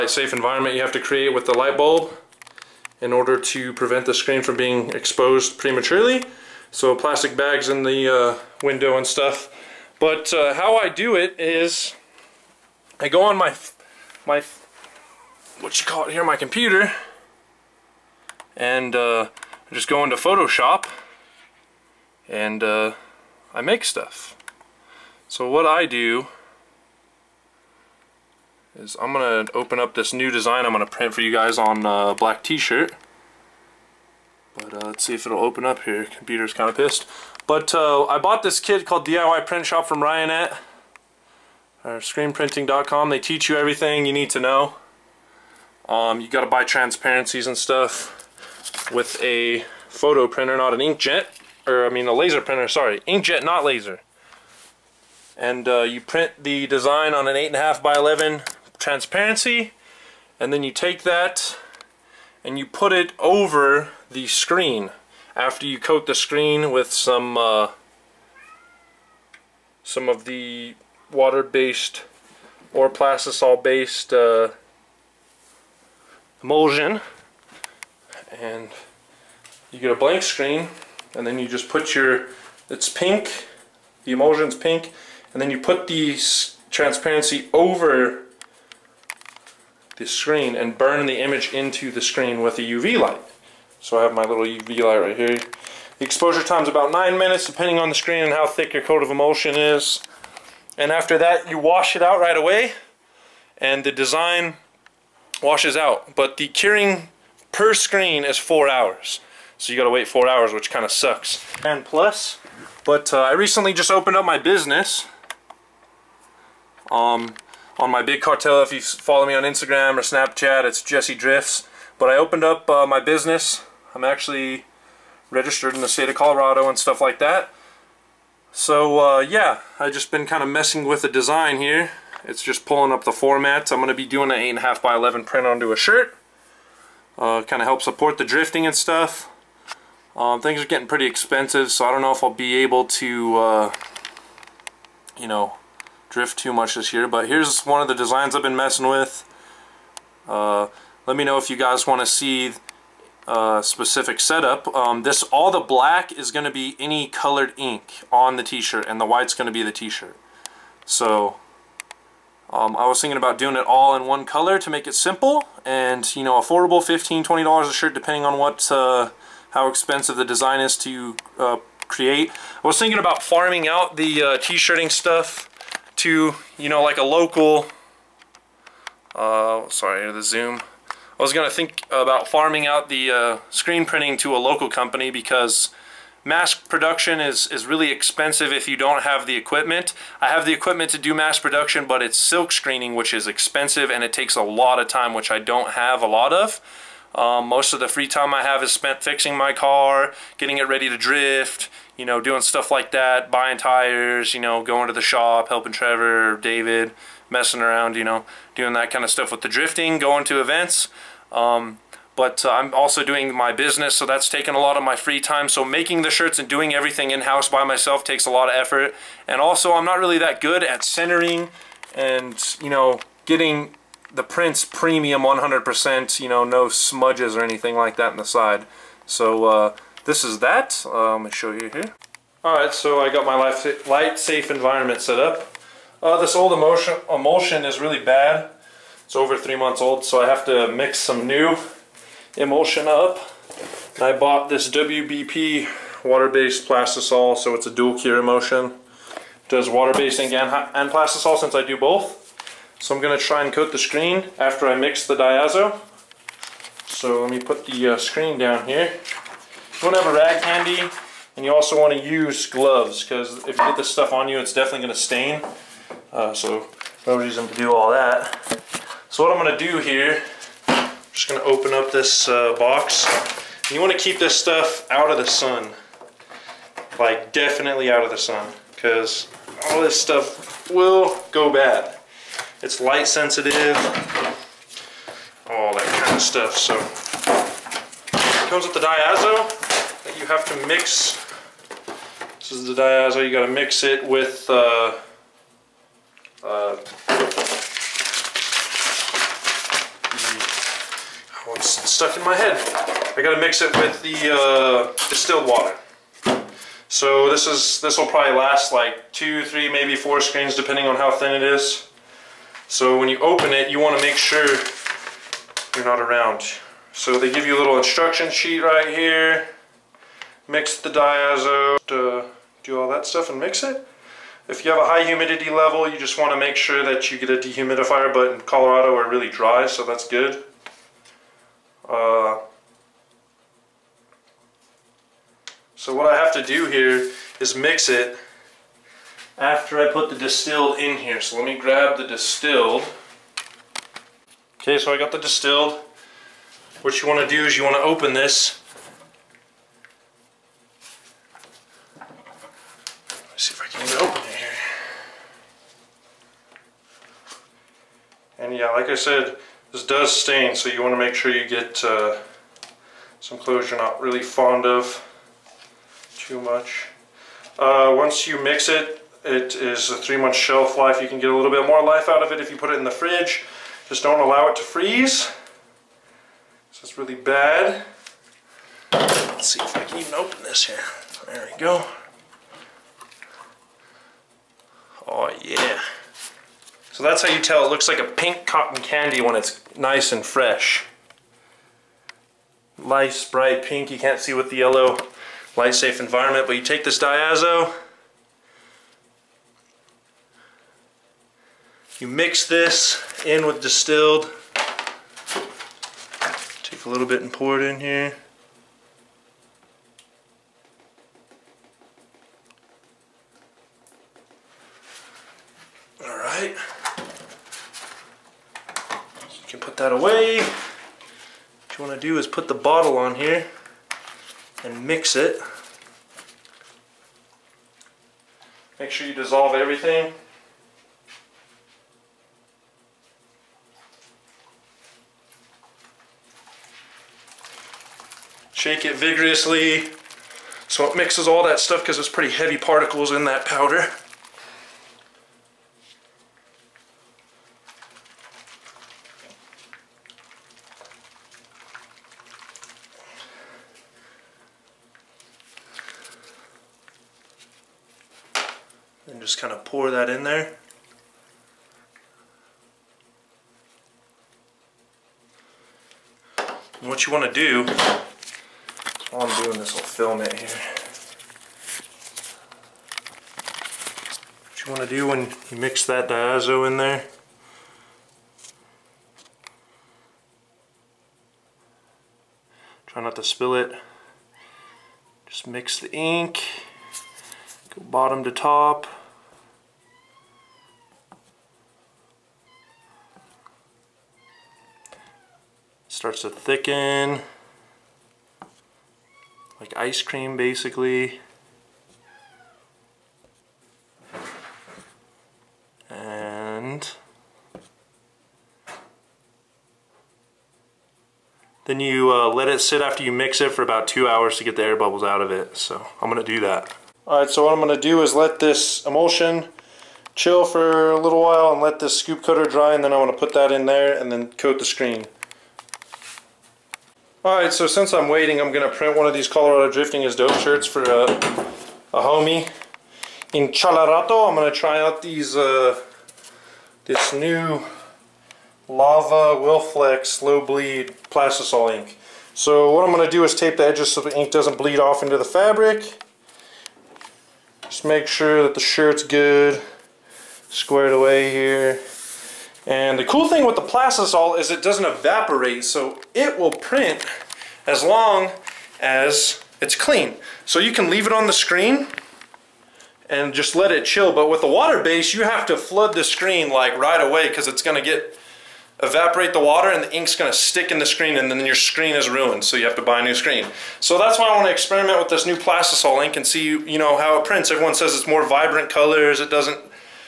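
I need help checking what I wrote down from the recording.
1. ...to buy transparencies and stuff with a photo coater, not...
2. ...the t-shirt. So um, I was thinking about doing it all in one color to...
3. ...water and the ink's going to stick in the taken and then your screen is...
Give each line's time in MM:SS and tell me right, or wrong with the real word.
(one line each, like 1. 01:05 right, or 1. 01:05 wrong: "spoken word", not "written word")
1. 00:46 wrong: "printer", not "coater"
2. 02:39 right
3. 09:29 wrong: "screen", not "taken".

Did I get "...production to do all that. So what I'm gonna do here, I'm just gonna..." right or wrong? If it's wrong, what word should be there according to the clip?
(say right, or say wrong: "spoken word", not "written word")
wrong: "reason", not "production".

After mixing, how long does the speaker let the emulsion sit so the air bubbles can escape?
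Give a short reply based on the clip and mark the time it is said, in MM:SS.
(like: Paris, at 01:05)
2 hours, at 08:33.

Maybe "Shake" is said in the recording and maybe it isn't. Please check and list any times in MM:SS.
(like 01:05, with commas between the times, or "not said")
07:18.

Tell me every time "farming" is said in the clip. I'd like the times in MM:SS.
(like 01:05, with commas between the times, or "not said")
02:53, 03:02.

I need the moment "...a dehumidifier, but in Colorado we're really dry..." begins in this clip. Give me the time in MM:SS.
05:27.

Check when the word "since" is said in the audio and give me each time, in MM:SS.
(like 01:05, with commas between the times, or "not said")
04:11, 08:47.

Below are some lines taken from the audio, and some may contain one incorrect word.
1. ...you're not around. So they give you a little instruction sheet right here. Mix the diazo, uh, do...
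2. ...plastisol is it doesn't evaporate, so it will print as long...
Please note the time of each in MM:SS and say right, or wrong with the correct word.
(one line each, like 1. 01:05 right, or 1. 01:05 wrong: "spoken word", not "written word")
1. 05:15 right
2. 09:13 right.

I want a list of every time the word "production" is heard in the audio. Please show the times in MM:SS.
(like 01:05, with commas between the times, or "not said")
03:06, 03:11.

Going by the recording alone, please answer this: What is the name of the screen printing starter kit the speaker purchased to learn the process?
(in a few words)
DIY Print Shop.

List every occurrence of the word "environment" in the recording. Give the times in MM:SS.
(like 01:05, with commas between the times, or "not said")
00:00, 03:54, 06:36.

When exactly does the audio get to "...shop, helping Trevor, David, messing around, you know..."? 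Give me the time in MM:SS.
03:25.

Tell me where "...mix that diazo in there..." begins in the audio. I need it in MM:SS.
07:55.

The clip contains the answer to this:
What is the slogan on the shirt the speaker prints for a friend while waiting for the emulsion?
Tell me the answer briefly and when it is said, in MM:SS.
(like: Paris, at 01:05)
Colorado Drifting is Dope, at 08:49.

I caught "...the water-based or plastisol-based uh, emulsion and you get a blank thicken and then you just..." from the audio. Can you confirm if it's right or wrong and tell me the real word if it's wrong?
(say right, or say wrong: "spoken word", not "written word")
wrong: "screen", not "thicken".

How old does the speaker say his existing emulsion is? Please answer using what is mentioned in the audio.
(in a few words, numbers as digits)
over 3 months.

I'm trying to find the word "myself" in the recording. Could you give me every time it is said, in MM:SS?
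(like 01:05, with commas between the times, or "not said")
03:37.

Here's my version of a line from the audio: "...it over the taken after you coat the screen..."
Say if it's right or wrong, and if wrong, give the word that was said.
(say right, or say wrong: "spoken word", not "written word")
wrong: "screen", not "taken".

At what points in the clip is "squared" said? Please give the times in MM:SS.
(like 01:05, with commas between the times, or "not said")
09:10.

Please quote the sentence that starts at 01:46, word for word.
But the curing per screen is four hours.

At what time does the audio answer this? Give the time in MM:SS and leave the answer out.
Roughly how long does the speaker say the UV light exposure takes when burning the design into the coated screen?
01:36.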